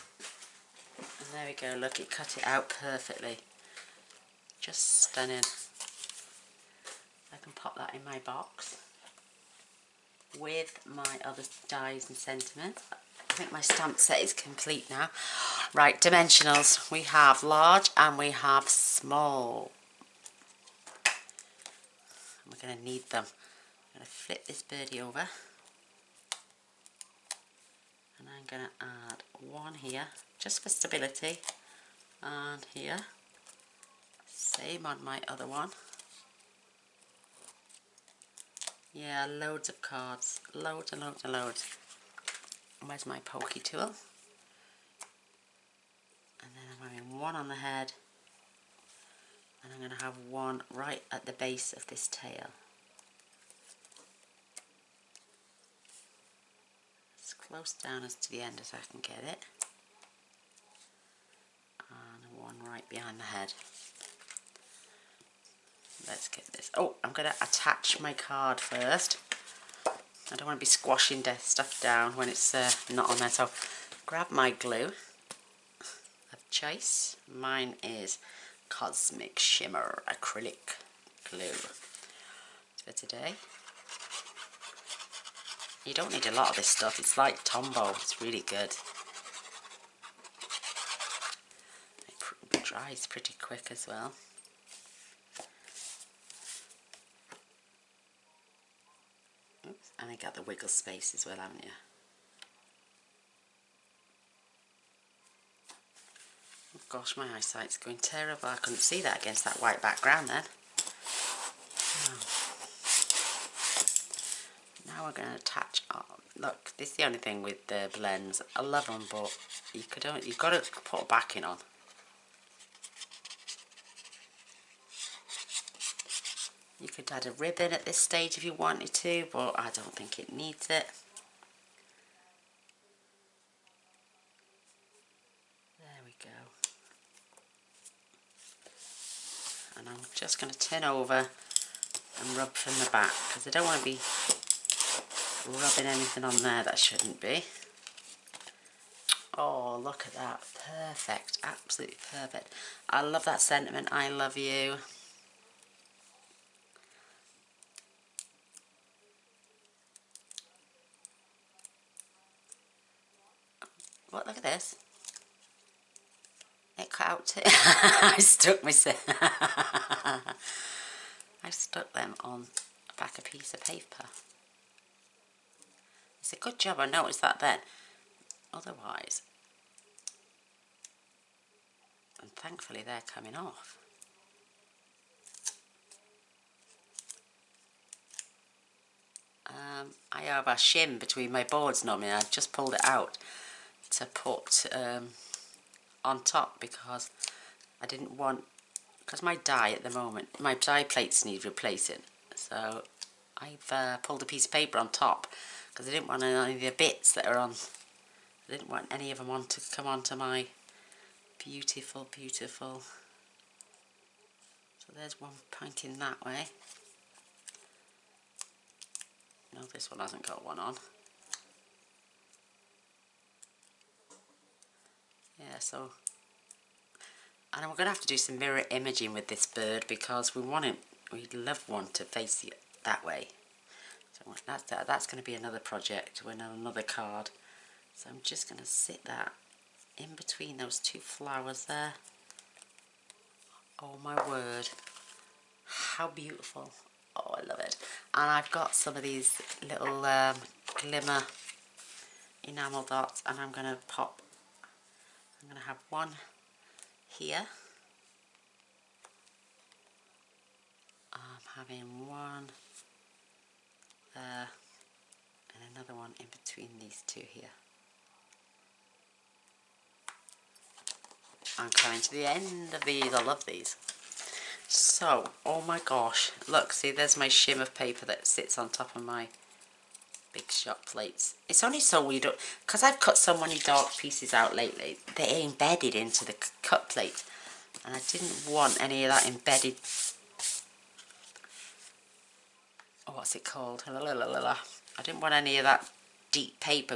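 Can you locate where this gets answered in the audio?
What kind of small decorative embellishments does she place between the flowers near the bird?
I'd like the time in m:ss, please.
4:10.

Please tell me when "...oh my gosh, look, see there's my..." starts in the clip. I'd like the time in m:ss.
4:35.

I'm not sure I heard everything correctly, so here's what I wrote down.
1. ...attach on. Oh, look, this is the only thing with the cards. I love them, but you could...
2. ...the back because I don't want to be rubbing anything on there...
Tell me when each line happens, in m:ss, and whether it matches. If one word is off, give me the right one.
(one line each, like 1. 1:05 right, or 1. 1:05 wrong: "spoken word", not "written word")
1. 1:55 wrong: "blends", not "cards"
2. 2:22 right.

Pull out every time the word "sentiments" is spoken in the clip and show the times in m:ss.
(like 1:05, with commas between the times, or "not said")
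0:12, 2:33.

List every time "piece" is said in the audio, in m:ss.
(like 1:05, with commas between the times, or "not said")
2:53, 3:24, 4:43.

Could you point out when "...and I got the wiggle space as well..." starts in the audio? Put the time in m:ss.
1:39.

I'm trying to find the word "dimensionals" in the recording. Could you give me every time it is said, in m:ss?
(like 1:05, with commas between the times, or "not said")
0:16.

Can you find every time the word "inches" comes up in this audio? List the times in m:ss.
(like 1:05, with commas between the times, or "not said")
not said.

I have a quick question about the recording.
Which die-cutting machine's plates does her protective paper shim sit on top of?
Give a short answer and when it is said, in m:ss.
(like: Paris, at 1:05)
Big Shot, at 4:40.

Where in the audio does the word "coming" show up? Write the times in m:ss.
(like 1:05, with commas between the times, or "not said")
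3:03, 4:31.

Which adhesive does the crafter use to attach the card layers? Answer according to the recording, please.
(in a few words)
Cosmic Shimmer Acrylic Glue.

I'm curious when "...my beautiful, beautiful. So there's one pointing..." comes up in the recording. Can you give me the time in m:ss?
3:30.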